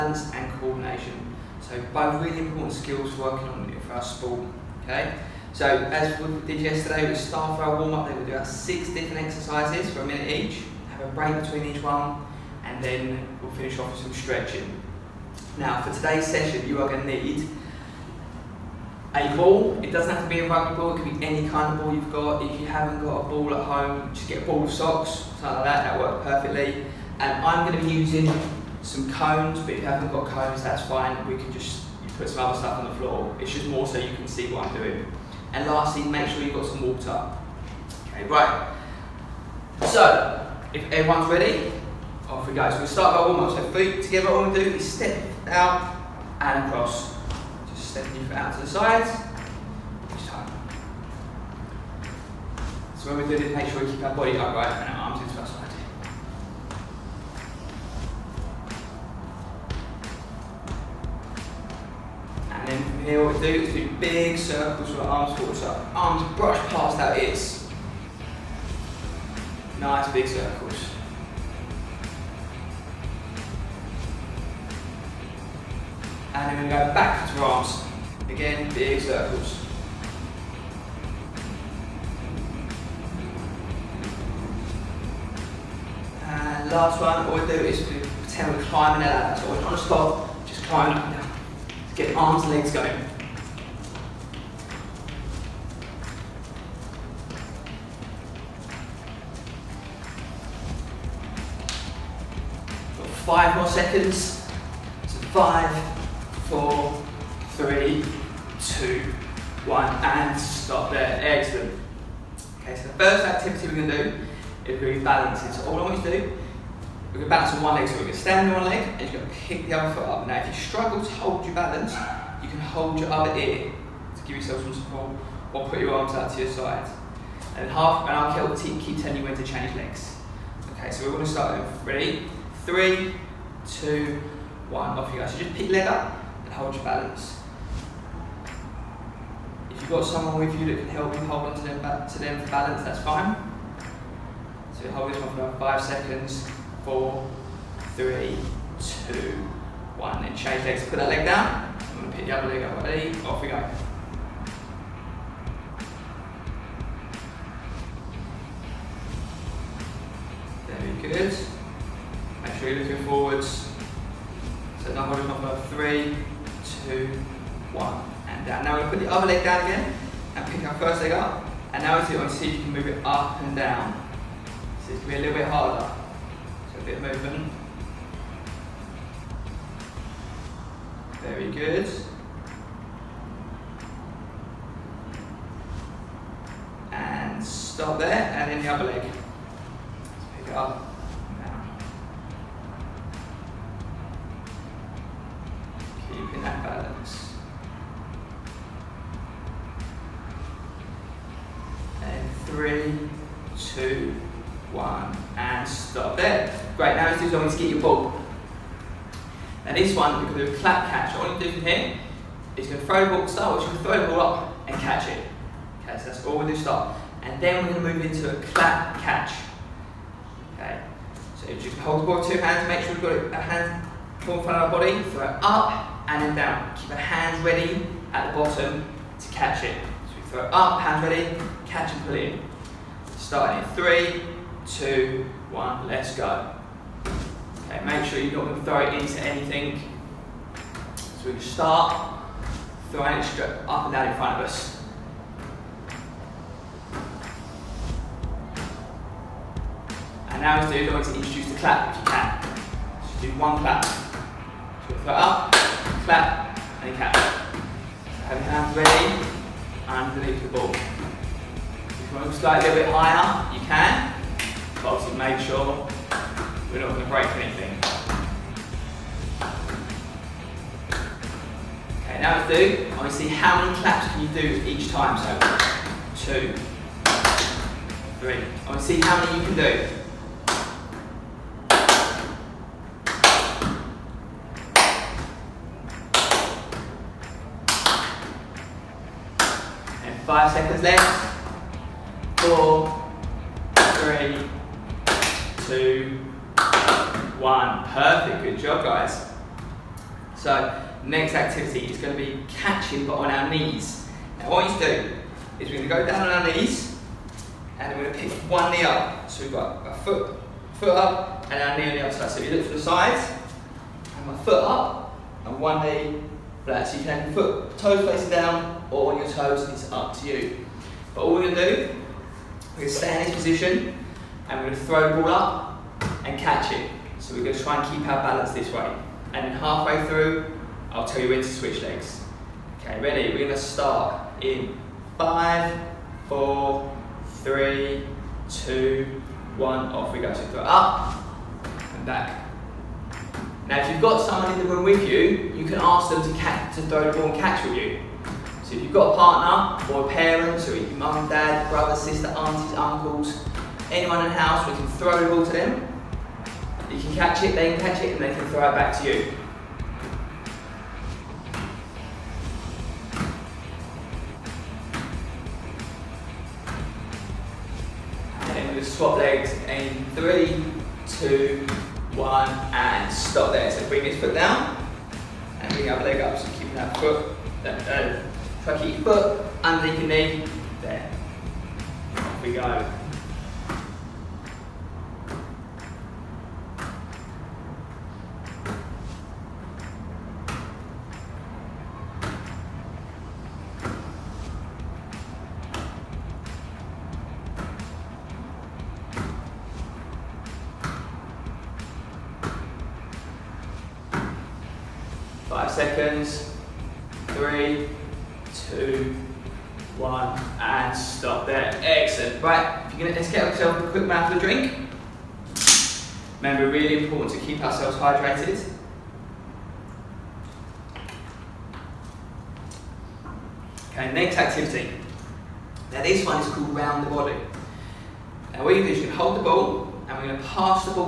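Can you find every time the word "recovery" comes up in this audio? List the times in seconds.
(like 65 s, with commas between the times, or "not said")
not said.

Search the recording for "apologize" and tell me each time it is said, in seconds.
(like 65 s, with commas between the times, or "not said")
not said.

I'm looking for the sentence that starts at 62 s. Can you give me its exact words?
And then from here what we do is do big circles with our arms forward.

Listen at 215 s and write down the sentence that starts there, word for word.
Okay, so that's all we do start.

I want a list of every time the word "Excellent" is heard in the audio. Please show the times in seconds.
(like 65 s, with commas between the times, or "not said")
111 s, 411 s.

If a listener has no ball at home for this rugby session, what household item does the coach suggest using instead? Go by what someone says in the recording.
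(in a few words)
A ball of socks.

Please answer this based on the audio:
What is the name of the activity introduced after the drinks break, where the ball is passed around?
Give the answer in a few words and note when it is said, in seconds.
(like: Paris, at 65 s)
Round the body, at 426 s.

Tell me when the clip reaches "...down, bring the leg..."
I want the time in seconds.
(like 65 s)
374 s.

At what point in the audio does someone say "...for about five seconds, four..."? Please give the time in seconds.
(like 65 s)
145 s.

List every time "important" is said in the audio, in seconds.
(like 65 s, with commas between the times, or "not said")
2 s, 417 s.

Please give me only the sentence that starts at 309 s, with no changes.
So we've got a foot, foot up and our knee on the other side.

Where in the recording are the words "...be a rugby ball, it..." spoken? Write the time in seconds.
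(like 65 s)
20 s.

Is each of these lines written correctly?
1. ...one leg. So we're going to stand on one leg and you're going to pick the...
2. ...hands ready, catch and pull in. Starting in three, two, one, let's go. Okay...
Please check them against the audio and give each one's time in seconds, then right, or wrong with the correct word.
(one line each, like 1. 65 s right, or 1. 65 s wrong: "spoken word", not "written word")
1. 117 s right
2. 230 s right.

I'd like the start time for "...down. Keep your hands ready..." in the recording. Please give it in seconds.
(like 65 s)
226 s.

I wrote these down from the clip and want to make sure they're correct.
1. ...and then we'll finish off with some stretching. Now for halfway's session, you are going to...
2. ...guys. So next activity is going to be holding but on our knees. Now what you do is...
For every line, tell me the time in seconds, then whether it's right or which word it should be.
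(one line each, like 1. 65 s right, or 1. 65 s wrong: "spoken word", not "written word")
1. 12 s wrong: "today", not "halfway"
2. 298 s wrong: "catching", not "holding".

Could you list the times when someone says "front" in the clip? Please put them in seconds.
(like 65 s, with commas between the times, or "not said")
224 s, 244 s.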